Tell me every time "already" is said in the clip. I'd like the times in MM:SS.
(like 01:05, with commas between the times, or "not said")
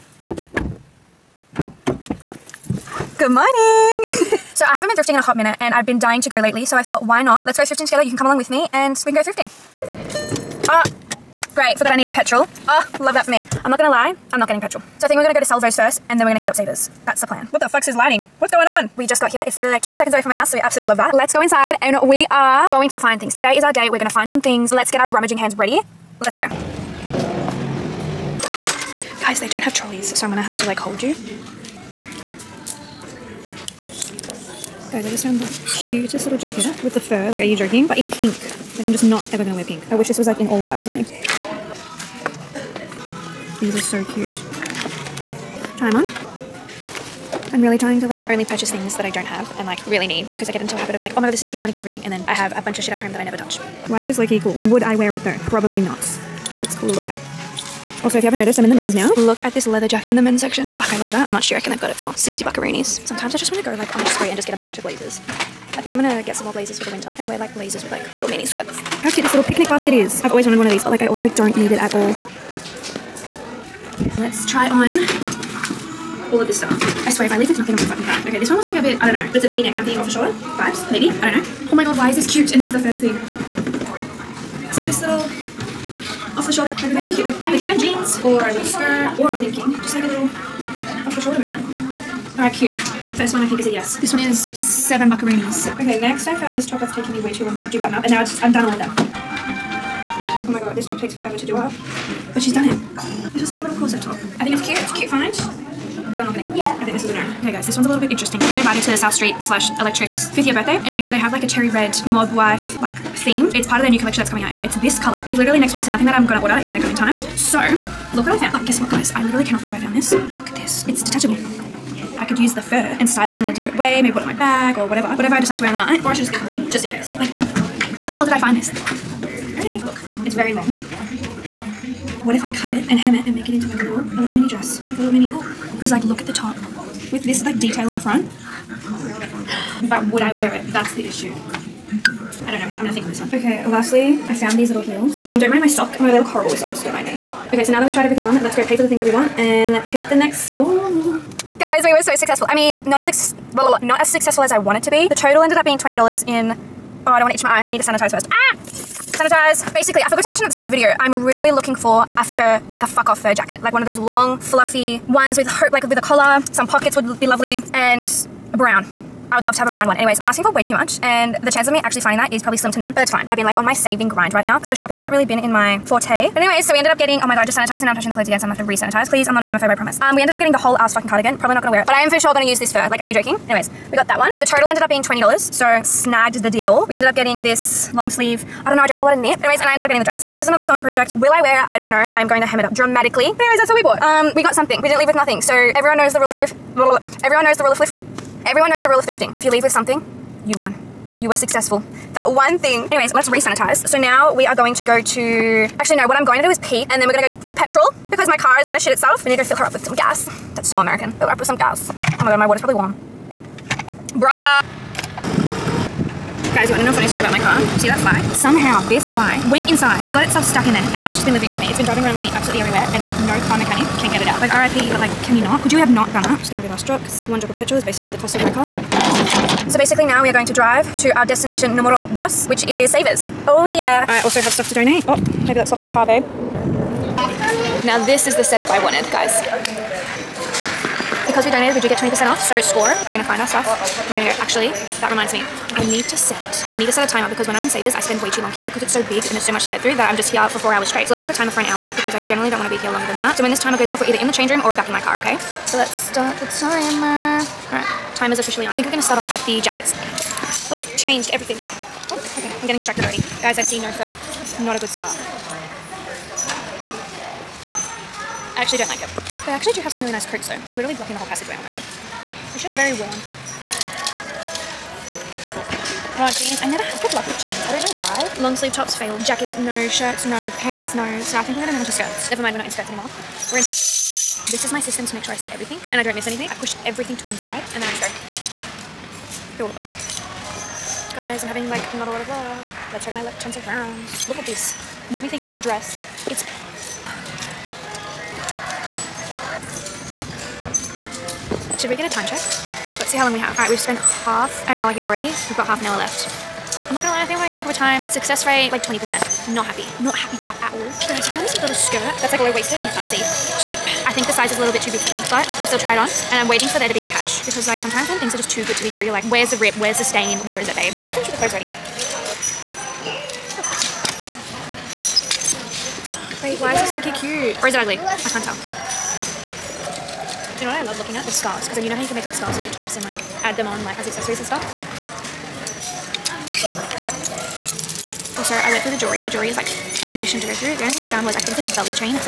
04:23, 05:05, 05:21.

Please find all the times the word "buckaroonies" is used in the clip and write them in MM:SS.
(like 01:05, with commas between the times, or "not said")
01:02, 01:35.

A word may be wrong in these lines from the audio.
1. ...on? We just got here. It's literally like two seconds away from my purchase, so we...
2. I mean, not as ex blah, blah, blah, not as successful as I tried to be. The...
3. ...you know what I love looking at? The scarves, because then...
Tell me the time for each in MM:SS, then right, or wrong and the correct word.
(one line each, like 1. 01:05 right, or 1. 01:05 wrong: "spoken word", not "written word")
1. 00:18 wrong: "house", not "purchase"
2. 02:32 wrong: "wanted", not "tried"
3. 05:30 right.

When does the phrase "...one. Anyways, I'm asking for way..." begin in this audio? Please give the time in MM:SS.
02:49.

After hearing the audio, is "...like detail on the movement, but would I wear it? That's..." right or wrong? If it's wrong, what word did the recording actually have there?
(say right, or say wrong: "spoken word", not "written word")
wrong: "front", not "movement".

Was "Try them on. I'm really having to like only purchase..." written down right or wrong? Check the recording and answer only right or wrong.
wrong.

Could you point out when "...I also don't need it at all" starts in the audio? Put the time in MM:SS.
01:11.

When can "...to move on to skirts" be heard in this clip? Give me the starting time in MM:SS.
04:41.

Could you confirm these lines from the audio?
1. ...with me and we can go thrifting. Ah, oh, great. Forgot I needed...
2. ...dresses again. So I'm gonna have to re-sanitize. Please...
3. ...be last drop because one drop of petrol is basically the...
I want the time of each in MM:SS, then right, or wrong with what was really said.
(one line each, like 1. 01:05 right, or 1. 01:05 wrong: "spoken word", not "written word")
1. 00:08 right
2. 02:58 wrong: "clothes", not "dresses"
3. 03:46 right.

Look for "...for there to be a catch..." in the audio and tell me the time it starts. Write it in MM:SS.
05:16.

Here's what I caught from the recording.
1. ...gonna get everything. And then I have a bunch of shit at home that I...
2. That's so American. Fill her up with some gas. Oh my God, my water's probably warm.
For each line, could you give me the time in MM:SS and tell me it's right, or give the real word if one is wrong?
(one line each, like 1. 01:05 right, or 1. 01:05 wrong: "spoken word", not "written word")
1. 00:51 right
2. 03:30 right.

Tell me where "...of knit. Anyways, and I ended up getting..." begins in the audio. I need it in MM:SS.
03:09.